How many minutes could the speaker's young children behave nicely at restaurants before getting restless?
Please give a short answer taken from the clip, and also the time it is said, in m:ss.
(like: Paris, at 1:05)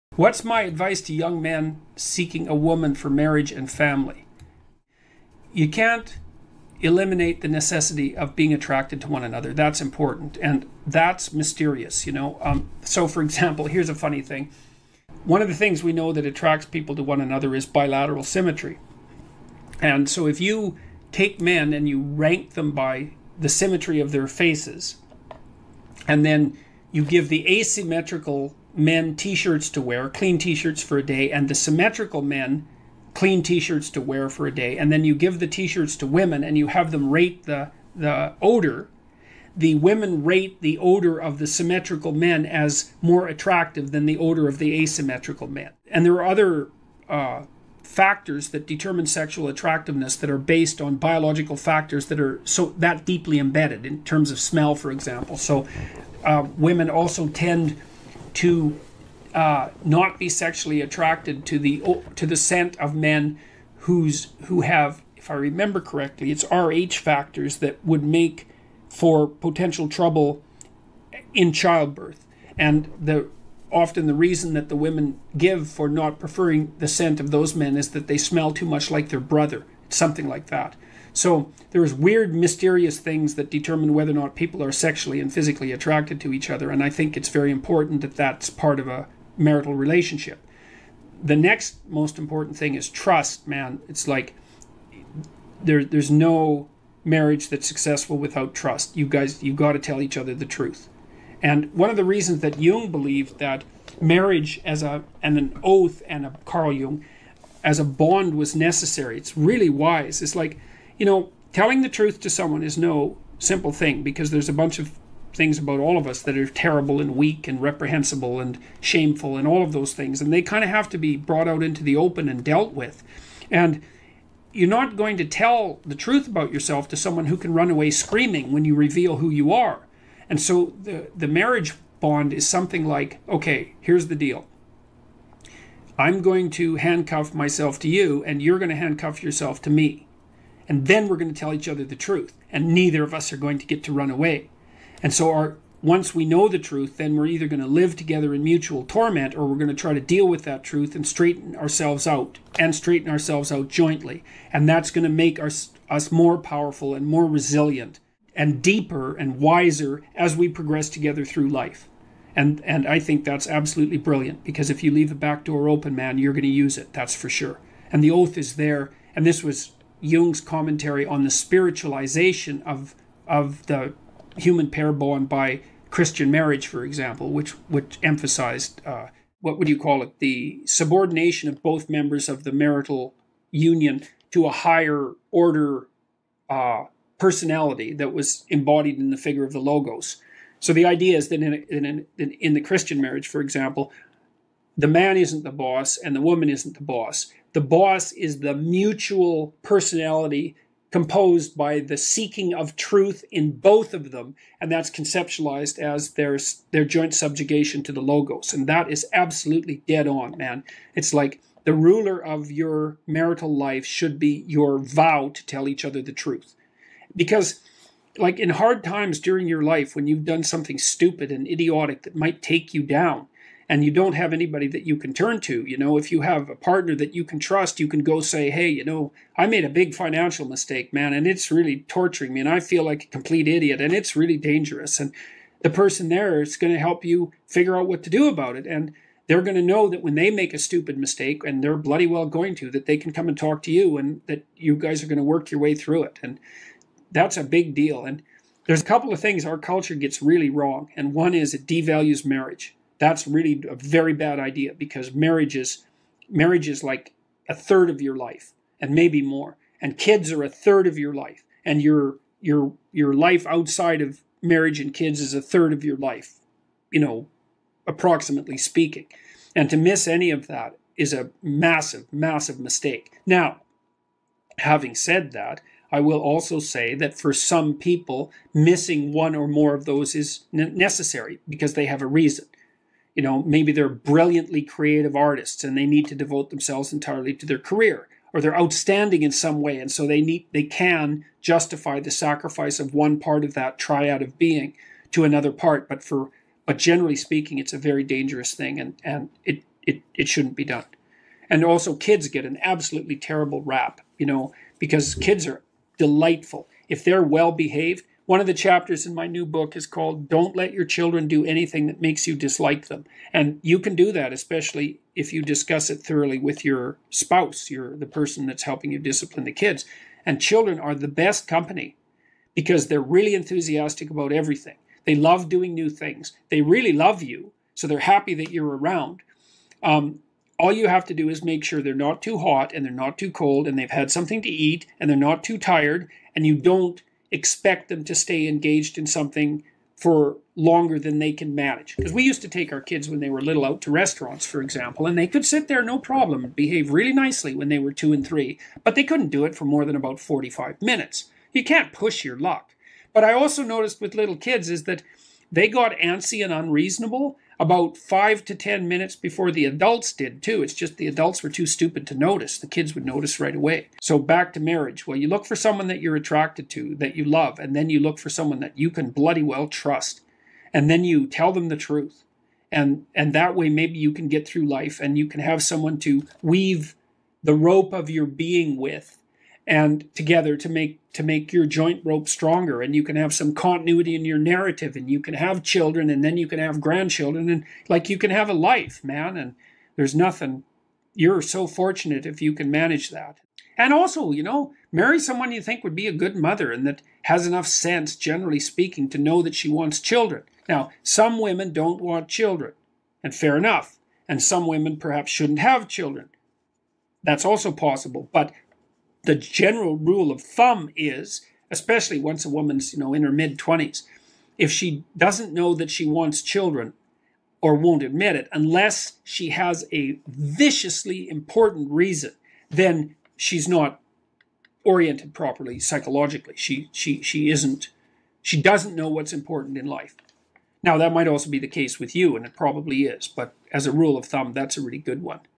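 45, at 5:50.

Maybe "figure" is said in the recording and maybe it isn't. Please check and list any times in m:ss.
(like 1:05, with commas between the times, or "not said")
3:09, 3:57.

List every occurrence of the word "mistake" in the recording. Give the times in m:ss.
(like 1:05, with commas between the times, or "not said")
3:50, 4:00, 4:32.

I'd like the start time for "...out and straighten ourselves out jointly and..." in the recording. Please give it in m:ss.
2:32.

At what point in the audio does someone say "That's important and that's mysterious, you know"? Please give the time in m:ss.
0:09.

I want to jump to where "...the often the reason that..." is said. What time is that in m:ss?
1:12.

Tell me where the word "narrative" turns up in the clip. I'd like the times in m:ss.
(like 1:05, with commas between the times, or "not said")
6:24.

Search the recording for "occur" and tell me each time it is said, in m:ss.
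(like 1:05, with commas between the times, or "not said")
not said.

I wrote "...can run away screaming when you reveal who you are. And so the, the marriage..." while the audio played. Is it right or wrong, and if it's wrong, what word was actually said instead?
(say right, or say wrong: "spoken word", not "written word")
right.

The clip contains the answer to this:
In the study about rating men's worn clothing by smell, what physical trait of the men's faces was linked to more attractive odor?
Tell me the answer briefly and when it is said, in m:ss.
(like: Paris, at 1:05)
bilateral symmetry, at 0:17.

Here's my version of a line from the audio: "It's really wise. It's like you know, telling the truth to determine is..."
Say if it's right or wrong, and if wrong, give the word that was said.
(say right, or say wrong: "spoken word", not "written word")
wrong: "someone", not "determine".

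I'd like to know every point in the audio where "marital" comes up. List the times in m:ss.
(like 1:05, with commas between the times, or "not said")
1:29, 3:02, 3:33.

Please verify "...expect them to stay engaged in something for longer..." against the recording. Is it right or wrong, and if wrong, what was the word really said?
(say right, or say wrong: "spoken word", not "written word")
right.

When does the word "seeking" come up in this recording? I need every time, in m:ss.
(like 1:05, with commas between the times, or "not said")
0:01, 3:21.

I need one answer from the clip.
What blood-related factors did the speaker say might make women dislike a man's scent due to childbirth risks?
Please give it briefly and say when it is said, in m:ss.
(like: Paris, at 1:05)
Rh factors, at 1:06.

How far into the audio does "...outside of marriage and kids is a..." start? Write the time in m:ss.
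4:23.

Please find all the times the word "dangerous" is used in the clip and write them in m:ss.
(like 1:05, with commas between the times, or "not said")
3:54, 4:58.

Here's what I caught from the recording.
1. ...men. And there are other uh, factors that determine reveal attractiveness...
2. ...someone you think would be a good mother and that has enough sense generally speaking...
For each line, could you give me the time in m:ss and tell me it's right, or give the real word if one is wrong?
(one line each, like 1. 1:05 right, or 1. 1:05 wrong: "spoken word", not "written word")
1. 0:45 wrong: "sexual", not "reveal"
2. 6:35 right.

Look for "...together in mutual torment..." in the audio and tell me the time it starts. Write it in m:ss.
2:27.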